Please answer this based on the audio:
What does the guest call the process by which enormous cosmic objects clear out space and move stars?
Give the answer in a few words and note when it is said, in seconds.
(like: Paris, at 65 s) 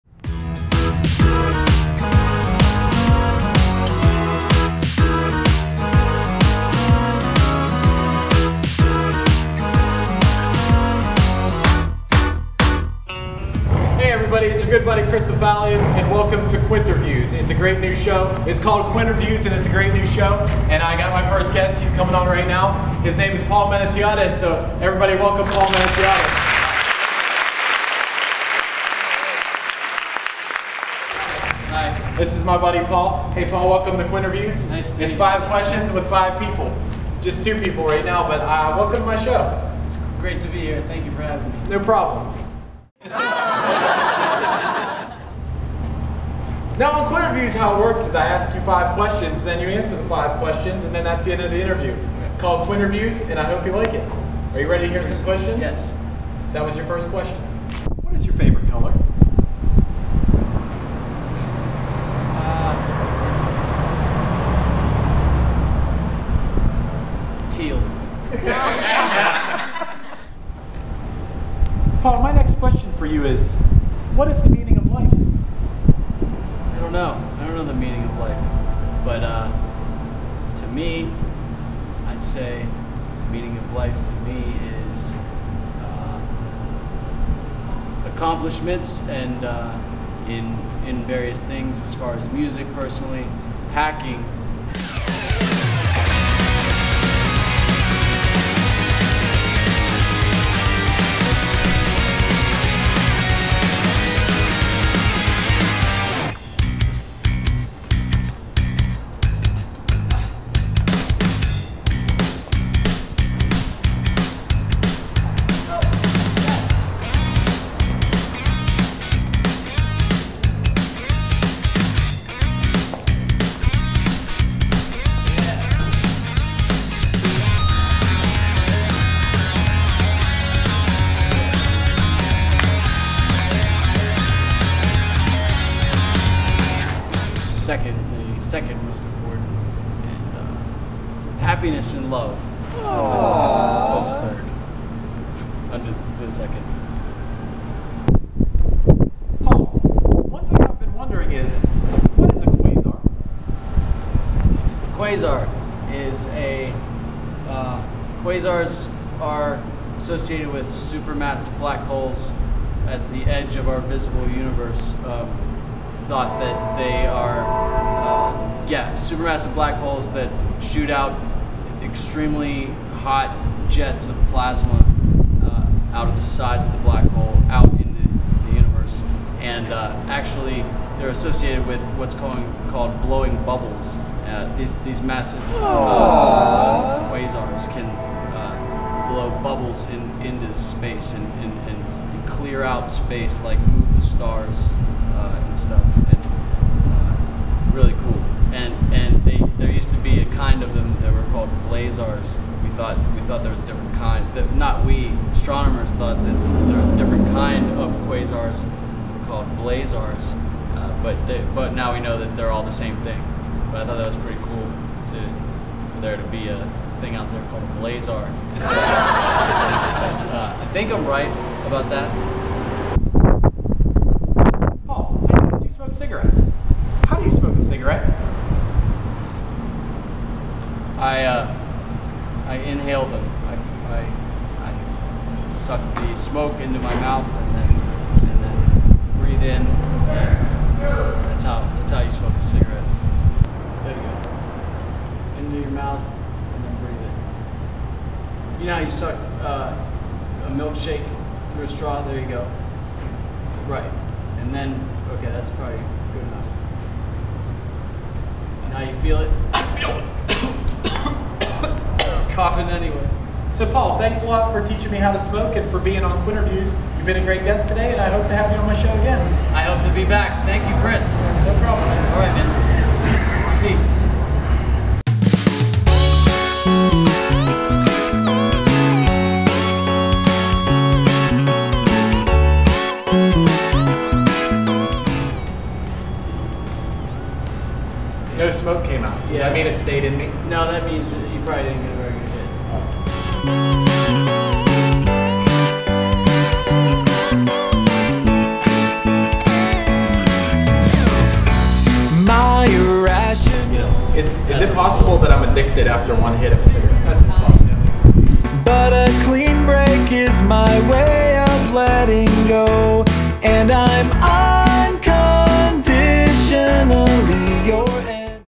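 Blowing bubbles, at 183 s.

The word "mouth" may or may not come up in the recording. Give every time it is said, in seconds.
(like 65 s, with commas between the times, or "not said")
236 s, 245 s.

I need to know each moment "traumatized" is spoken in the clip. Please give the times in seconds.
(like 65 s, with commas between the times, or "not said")
not said.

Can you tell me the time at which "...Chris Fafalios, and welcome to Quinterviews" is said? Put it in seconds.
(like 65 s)
15 s.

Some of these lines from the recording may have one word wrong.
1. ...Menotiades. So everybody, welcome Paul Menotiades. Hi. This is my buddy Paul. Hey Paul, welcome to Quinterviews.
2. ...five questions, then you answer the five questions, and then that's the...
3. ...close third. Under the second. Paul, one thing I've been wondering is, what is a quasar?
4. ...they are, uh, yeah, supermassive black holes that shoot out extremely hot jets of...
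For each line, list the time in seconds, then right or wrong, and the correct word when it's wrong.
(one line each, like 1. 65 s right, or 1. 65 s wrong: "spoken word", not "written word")
1. 23 s right
2. 48 s right
3. 144 s right
4. 166 s right.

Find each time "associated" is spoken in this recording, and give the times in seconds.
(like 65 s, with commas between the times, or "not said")
159 s, 181 s.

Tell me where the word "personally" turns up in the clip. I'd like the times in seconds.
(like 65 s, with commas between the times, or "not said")
92 s.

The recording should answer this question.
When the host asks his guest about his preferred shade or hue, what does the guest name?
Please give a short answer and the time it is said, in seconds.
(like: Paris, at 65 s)
Teal, at 71 s.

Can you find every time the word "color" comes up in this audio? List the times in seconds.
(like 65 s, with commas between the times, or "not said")
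58 s.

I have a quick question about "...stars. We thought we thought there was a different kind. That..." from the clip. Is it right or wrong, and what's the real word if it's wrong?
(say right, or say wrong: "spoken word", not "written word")
wrong: "blazars", not "stars".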